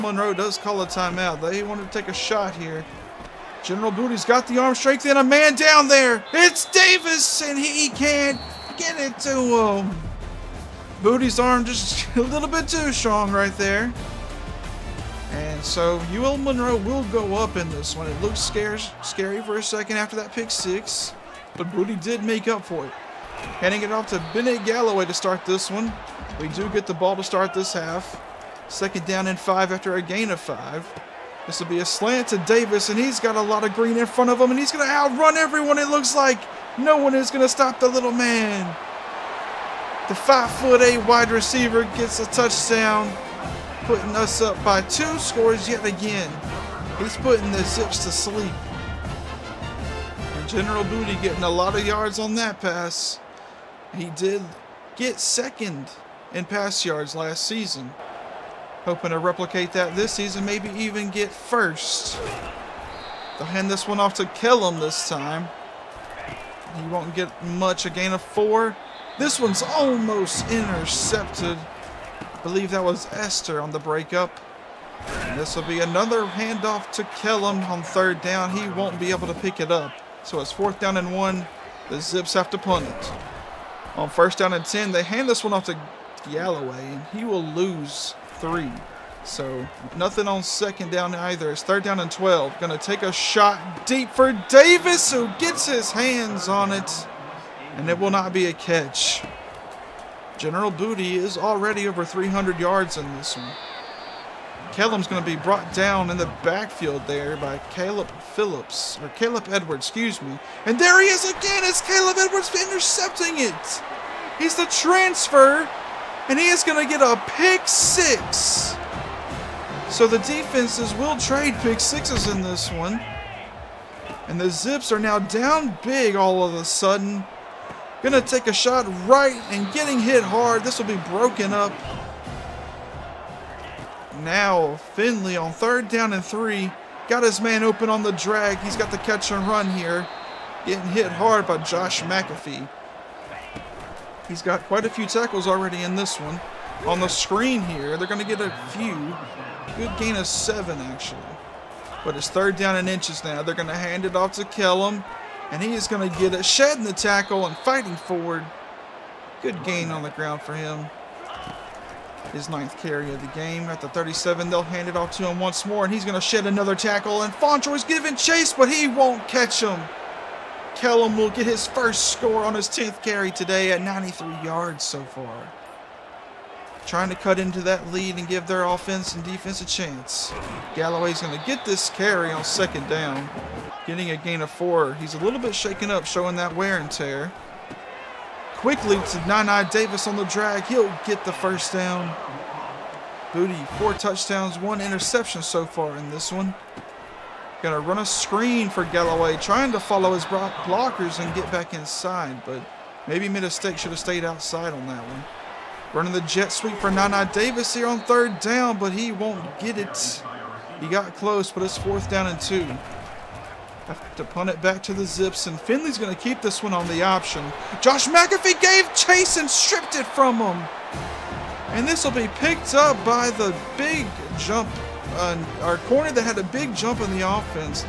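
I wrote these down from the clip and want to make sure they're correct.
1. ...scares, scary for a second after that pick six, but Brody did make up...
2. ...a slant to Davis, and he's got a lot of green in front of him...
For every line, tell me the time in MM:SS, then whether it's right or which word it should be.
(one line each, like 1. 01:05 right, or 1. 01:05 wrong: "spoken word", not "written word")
1. 00:18 right
2. 00:31 right.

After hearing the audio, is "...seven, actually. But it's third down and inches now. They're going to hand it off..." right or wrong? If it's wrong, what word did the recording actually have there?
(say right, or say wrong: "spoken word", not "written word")
right.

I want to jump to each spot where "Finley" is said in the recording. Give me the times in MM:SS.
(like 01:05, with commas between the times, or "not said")
02:14, 03:35.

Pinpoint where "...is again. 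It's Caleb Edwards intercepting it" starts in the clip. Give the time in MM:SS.
01:51.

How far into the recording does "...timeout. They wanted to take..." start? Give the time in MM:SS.
00:00.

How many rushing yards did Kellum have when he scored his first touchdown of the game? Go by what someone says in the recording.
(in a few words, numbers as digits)
93.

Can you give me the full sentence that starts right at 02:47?
And Fontroy's giving chase, but he won't catch him.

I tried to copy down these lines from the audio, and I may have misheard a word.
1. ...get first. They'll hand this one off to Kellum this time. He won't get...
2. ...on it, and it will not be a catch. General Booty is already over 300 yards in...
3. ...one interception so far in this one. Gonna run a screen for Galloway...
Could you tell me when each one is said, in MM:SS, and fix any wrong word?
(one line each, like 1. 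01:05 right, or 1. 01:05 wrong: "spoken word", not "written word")
1. 01:01 right
2. 01:36 right
3. 03:14 right.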